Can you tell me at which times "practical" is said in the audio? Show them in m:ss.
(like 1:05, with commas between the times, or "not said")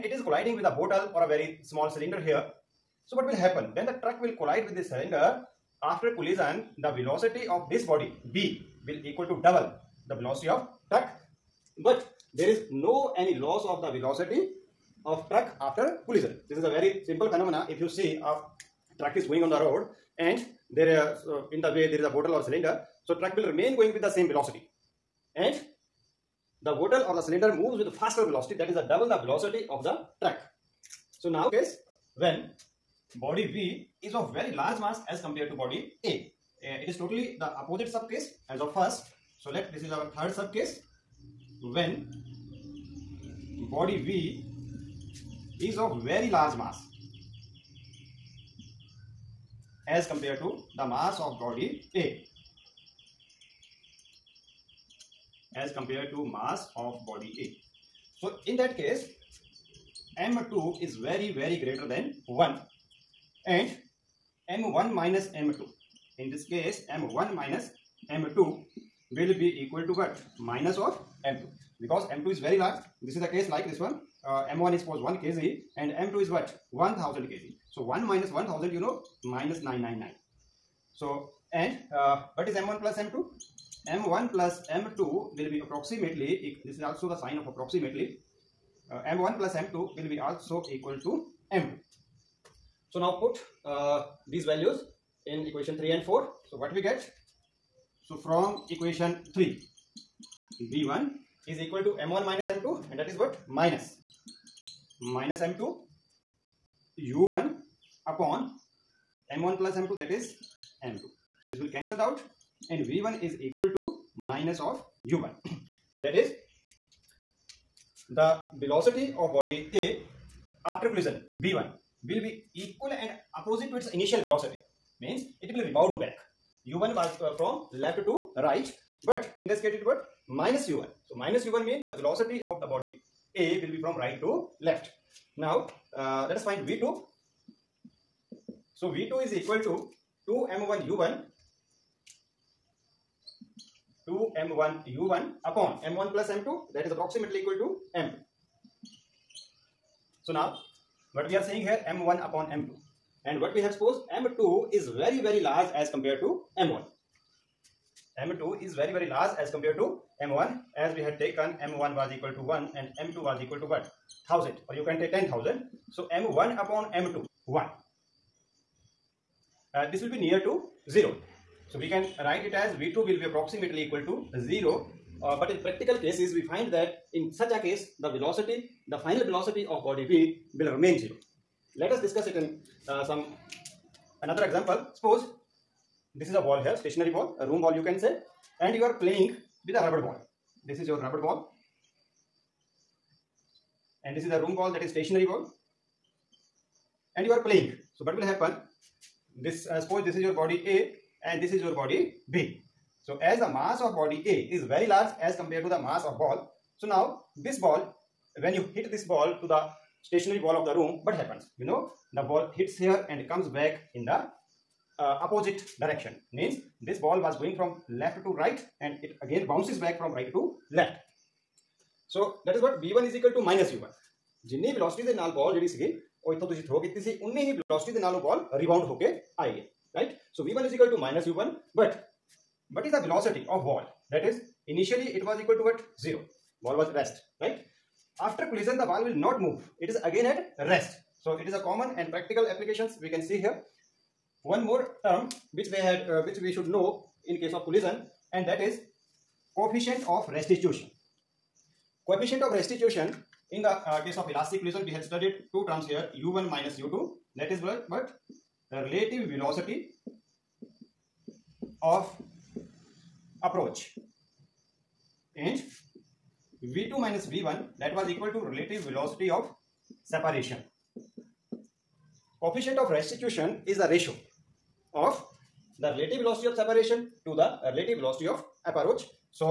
2:55, 4:02.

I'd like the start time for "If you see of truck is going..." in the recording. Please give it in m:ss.
0:17.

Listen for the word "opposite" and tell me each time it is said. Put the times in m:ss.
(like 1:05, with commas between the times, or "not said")
0:37, 2:03, 3:35.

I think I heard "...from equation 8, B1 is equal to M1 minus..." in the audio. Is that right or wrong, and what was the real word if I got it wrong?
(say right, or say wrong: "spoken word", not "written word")
wrong: "3", not "8".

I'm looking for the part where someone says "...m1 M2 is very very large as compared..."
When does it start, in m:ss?
2:36.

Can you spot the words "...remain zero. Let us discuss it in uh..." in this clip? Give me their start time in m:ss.
3:00.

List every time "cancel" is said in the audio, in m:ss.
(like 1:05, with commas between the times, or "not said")
1:51.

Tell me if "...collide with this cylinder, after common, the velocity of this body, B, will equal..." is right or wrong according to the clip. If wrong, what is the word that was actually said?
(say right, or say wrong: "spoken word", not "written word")
wrong: "collision", not "common".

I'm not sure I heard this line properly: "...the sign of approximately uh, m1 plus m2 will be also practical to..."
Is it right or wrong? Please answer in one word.
wrong.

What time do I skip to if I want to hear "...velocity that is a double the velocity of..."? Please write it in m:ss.
0:28.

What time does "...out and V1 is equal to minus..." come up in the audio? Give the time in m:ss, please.
1:52.